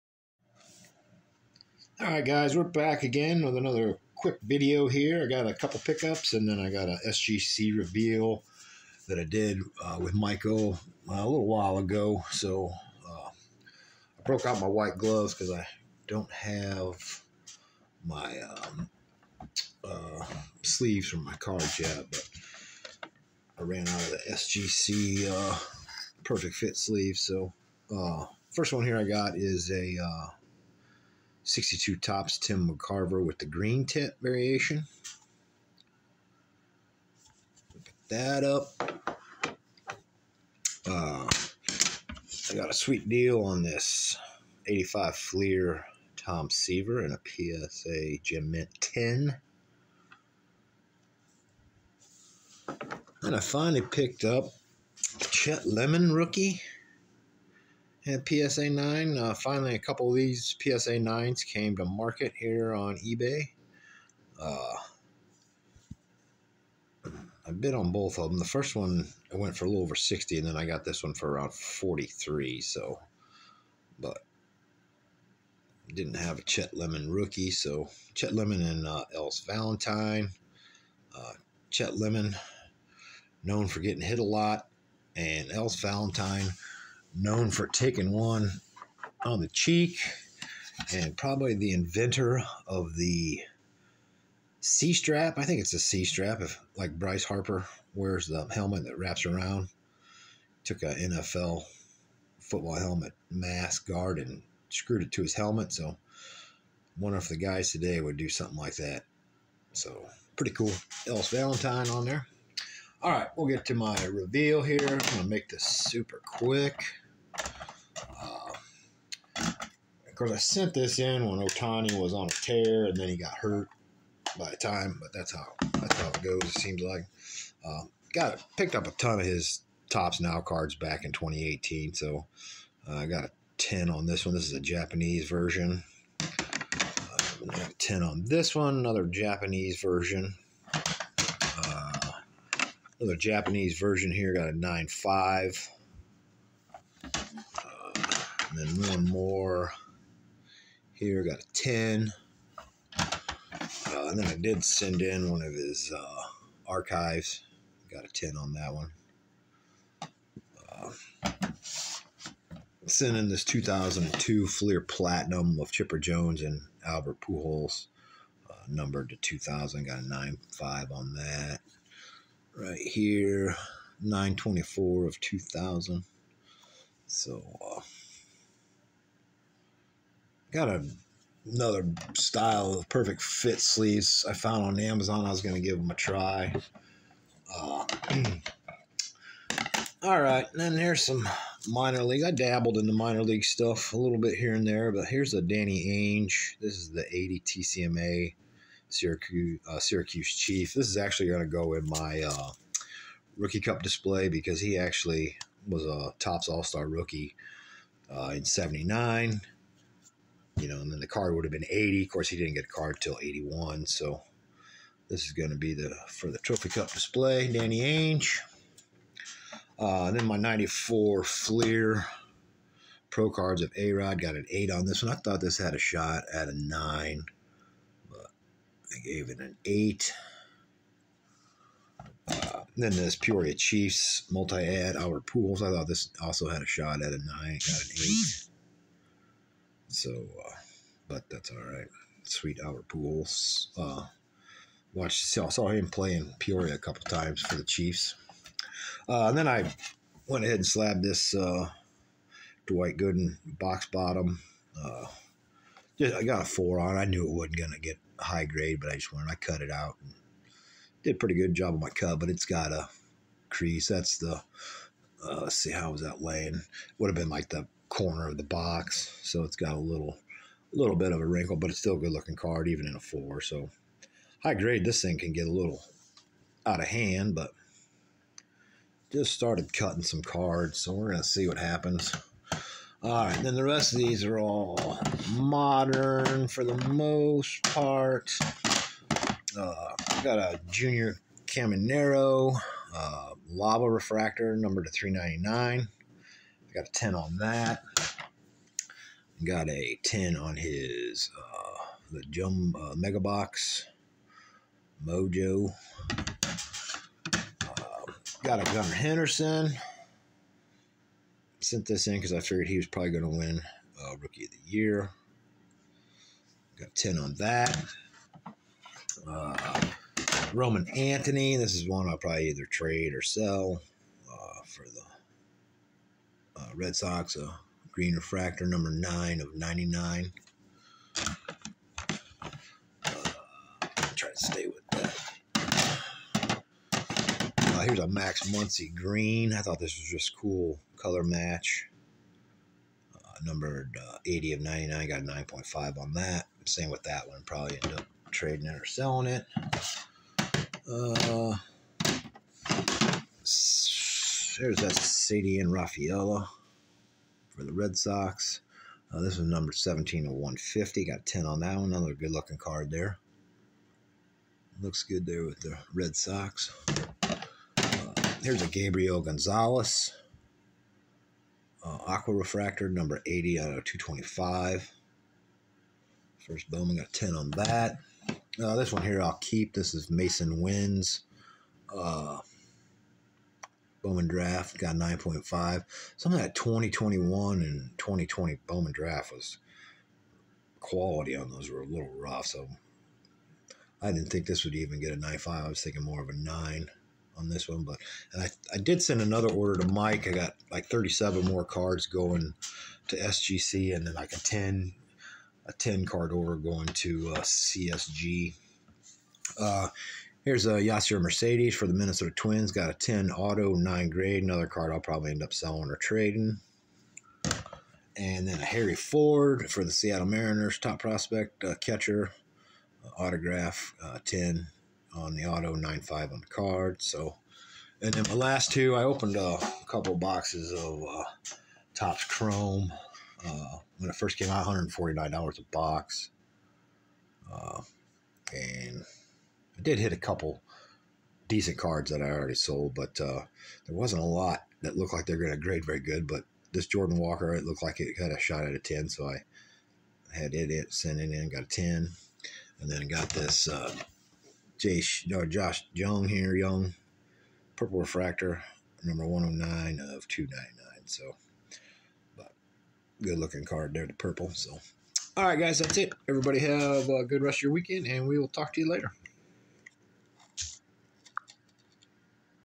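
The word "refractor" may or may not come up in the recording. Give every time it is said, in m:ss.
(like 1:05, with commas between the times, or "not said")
4:53, 5:28, 6:12, 7:37.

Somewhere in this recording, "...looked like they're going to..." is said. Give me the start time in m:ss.
7:24.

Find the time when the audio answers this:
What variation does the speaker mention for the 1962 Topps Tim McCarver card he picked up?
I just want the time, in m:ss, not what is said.
0:33.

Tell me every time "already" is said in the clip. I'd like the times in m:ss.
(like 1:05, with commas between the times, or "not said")
7:22.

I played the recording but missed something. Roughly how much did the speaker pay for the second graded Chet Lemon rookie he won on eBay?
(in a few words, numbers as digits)
around 43.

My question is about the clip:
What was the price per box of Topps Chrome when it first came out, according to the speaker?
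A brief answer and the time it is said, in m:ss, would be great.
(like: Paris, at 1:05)
$149, at 7:14.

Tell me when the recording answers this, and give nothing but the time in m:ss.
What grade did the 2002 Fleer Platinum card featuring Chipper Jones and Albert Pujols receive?
2:49.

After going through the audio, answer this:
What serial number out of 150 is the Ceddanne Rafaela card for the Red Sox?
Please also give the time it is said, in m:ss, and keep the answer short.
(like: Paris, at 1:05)
17, at 5:59.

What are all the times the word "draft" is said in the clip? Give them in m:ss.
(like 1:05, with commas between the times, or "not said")
6:24, 6:28.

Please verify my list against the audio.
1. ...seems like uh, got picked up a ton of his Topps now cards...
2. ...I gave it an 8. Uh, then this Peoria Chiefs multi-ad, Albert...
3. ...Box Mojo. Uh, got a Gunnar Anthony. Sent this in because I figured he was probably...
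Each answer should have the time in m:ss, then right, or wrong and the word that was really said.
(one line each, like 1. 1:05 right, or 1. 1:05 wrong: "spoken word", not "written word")
1. 2:06 right
2. 3:48 right
3. 5:03 wrong: "Henderson", not "Anthony".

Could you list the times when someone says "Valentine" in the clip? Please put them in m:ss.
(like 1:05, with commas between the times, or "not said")
1:19, 1:25, 1:51.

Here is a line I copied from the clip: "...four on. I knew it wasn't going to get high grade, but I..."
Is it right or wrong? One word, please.
right.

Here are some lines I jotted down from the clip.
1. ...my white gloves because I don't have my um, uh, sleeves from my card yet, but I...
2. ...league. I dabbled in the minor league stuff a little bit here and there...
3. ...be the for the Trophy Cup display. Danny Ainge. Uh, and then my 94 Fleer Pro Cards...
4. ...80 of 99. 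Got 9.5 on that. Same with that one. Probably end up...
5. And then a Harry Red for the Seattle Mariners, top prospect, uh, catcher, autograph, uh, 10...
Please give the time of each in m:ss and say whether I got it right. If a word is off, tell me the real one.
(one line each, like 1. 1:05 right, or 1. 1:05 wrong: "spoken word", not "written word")
1. 0:14 right
2. 3:12 right
3. 3:35 right
4. 5:44 right
5. 6:58 wrong: "Ford", not "Red".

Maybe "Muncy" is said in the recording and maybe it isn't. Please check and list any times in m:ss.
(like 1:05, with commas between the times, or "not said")
5:38.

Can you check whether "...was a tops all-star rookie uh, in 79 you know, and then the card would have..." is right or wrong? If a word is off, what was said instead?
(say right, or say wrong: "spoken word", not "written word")
right.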